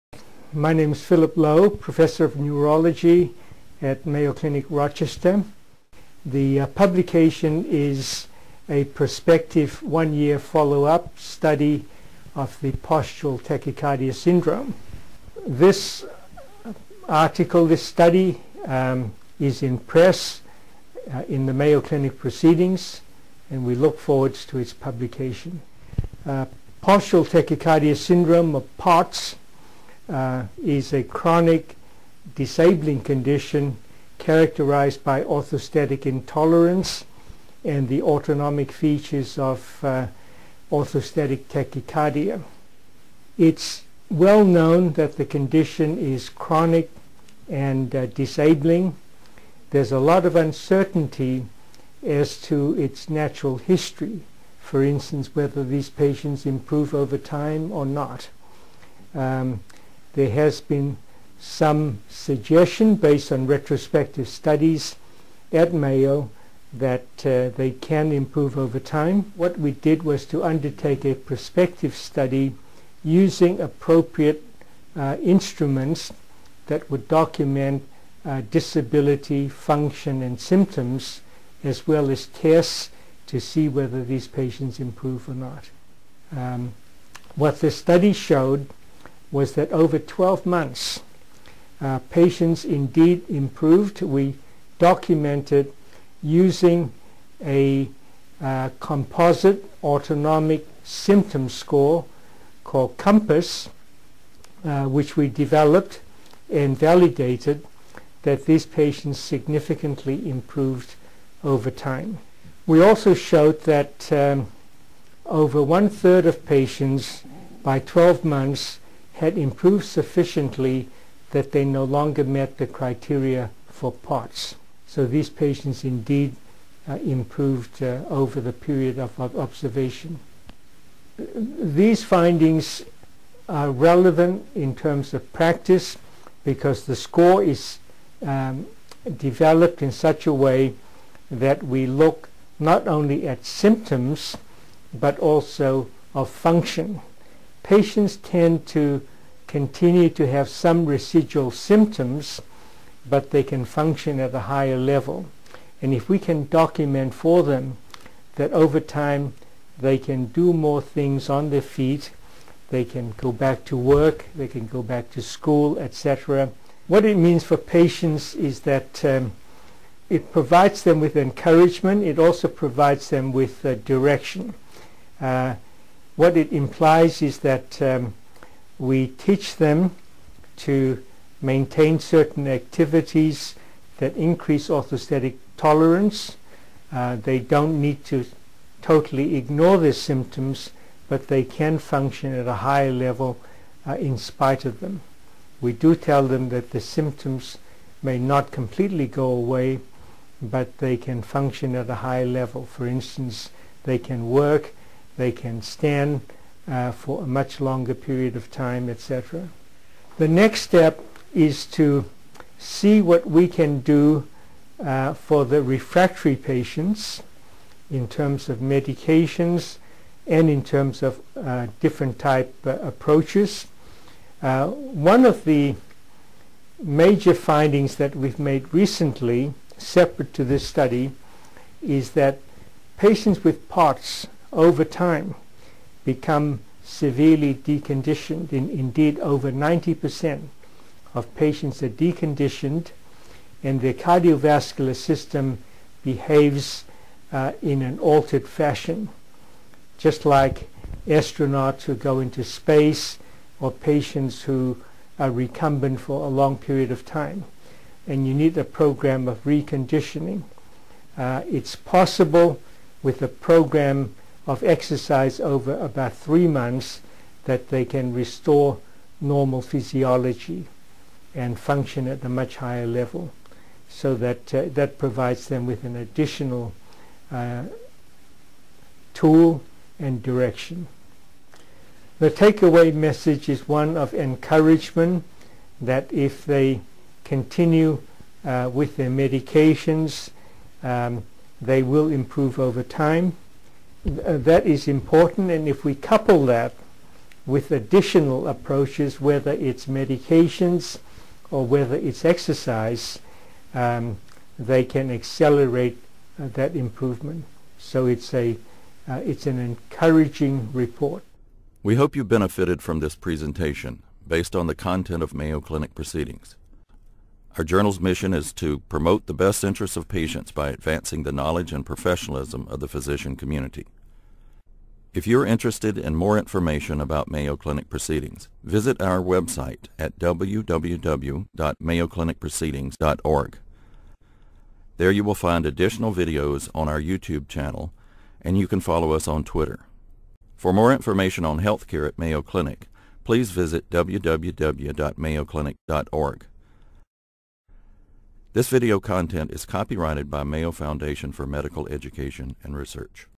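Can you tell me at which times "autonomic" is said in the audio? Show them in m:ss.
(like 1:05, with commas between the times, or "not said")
0:38, 1:39.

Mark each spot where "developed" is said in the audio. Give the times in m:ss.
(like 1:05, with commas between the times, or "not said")
1:45, 2:19.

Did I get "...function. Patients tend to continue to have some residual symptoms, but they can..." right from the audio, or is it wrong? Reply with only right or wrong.
right.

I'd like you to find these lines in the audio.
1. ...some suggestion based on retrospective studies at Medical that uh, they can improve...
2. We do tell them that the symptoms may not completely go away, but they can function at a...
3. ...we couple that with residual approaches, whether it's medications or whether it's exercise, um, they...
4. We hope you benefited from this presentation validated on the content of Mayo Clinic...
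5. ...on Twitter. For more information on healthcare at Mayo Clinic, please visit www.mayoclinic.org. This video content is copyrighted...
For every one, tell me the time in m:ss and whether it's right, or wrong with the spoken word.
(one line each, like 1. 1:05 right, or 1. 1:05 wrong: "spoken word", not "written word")
1. 1:01 wrong: "Mayo", not "Medical"
2. 3:15 right
3. 4:55 wrong: "additional", not "residual"
4. 5:11 wrong: "based", not "validated"
5. 5:39 right.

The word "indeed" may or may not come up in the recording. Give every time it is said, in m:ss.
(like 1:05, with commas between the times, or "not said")
1:32, 2:05, 3:58.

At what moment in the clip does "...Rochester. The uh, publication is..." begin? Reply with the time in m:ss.
0:04.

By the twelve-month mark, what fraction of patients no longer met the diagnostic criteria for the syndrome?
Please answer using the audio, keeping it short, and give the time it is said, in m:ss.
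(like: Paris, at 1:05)
over one-third, at 1:55.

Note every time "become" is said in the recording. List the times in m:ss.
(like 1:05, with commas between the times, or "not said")
3:56.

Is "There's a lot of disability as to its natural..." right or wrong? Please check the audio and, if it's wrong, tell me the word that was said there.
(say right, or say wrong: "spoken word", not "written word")
wrong: "uncertainty", not "disability".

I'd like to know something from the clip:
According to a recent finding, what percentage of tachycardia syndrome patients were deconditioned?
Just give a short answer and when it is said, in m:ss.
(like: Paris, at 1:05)
over 90%, at 3:59.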